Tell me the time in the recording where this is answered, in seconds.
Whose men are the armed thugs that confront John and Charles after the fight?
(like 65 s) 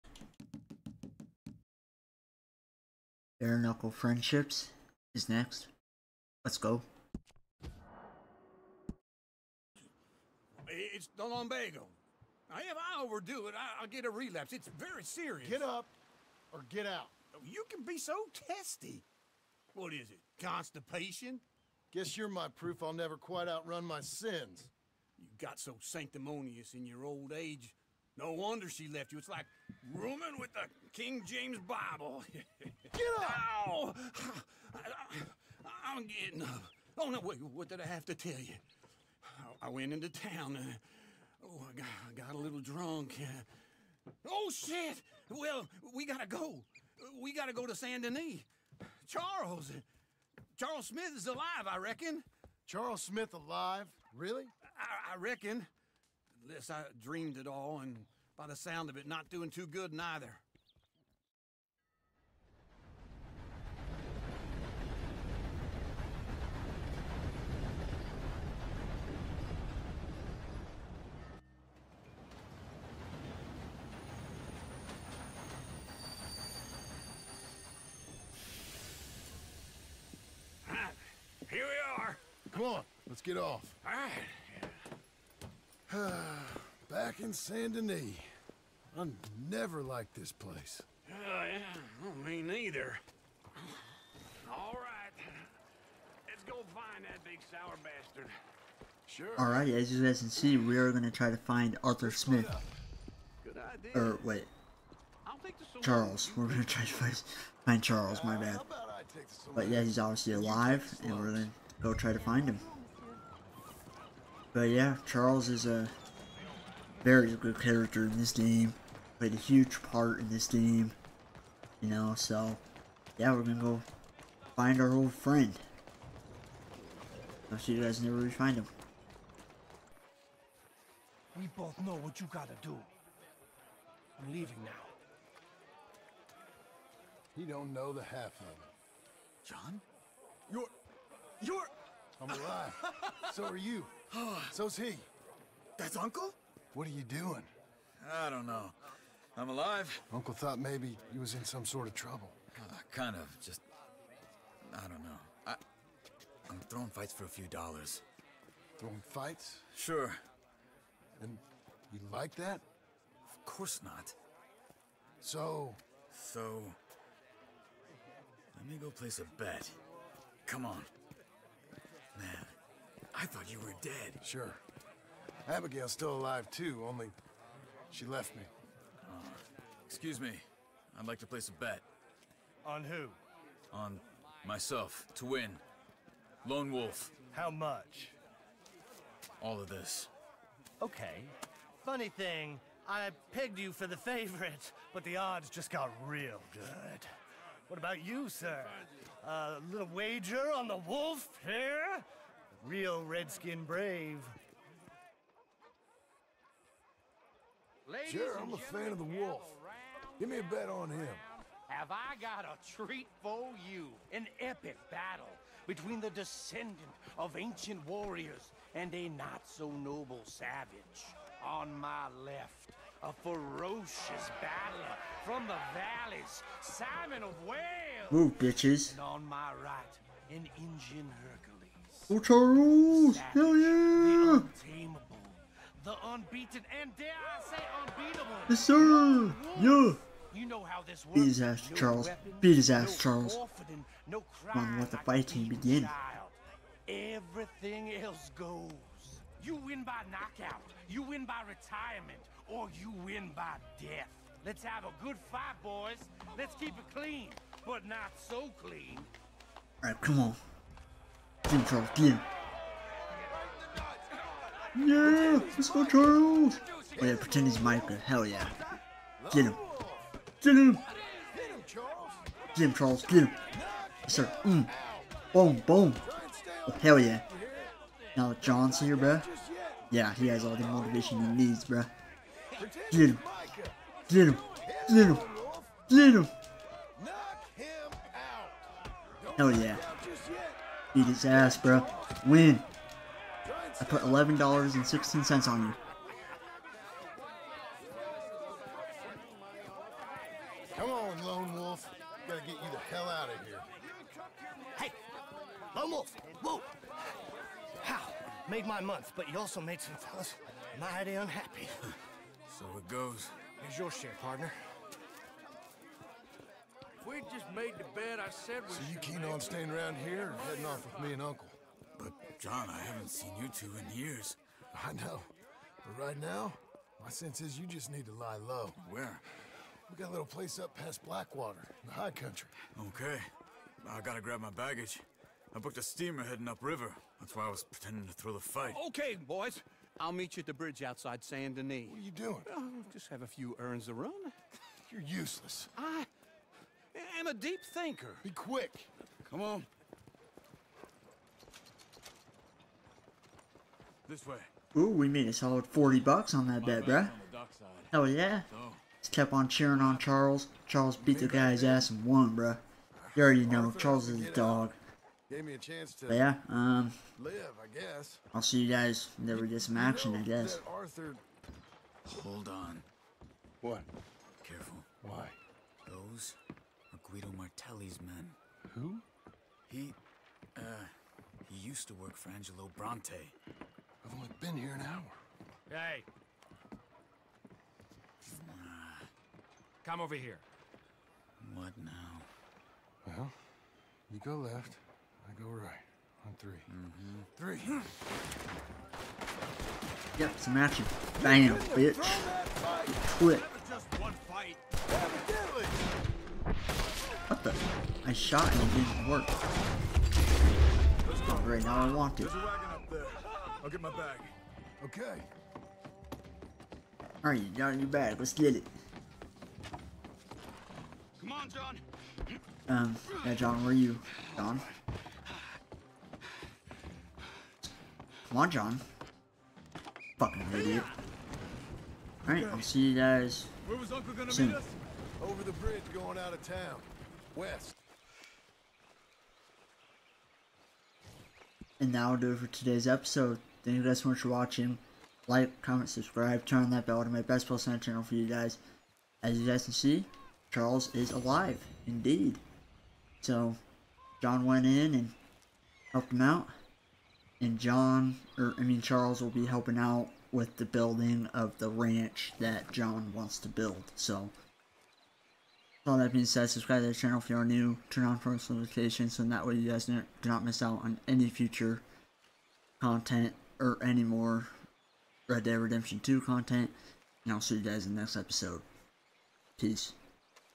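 377 s.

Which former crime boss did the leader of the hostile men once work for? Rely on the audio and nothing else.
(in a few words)
Angelo Bronte.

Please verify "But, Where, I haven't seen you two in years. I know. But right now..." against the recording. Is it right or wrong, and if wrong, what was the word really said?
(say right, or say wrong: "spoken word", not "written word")
wrong: "John", not "Where".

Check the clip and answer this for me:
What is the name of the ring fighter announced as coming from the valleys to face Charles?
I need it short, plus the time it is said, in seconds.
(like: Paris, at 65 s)
Simon of Wales, at 226 s.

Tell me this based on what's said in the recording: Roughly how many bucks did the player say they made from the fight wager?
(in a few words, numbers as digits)
40.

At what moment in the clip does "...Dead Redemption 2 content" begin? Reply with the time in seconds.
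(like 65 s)
475 s.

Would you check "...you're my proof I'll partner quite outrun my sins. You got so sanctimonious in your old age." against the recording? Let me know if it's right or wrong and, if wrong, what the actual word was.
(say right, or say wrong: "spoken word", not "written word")
wrong: "never", not "partner".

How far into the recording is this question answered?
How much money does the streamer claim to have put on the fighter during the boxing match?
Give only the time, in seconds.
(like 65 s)
294 s.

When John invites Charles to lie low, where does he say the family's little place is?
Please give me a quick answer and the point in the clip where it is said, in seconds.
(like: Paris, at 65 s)
past Blackwater, at 330 s.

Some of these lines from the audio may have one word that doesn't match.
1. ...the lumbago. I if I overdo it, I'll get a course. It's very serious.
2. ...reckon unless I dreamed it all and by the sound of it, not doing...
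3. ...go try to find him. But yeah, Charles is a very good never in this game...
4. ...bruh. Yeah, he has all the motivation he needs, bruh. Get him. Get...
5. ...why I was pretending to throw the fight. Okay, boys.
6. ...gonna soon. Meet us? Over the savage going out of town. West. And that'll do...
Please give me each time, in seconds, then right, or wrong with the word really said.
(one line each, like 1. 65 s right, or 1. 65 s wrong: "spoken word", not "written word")
1. 11 s wrong: "relapse", not "course"
2. 55 s right
3. 111 s wrong: "character", not "never"
4. 278 s right
5. 337 s right
6. 434 s wrong: "bridge", not "savage".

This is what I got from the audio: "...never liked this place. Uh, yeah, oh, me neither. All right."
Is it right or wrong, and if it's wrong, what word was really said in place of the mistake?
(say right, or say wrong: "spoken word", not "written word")
right.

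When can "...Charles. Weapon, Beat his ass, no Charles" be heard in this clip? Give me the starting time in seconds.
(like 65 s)
241 s.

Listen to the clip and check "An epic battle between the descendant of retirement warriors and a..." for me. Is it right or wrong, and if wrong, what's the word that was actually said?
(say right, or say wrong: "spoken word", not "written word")
wrong: "ancient", not "retirement".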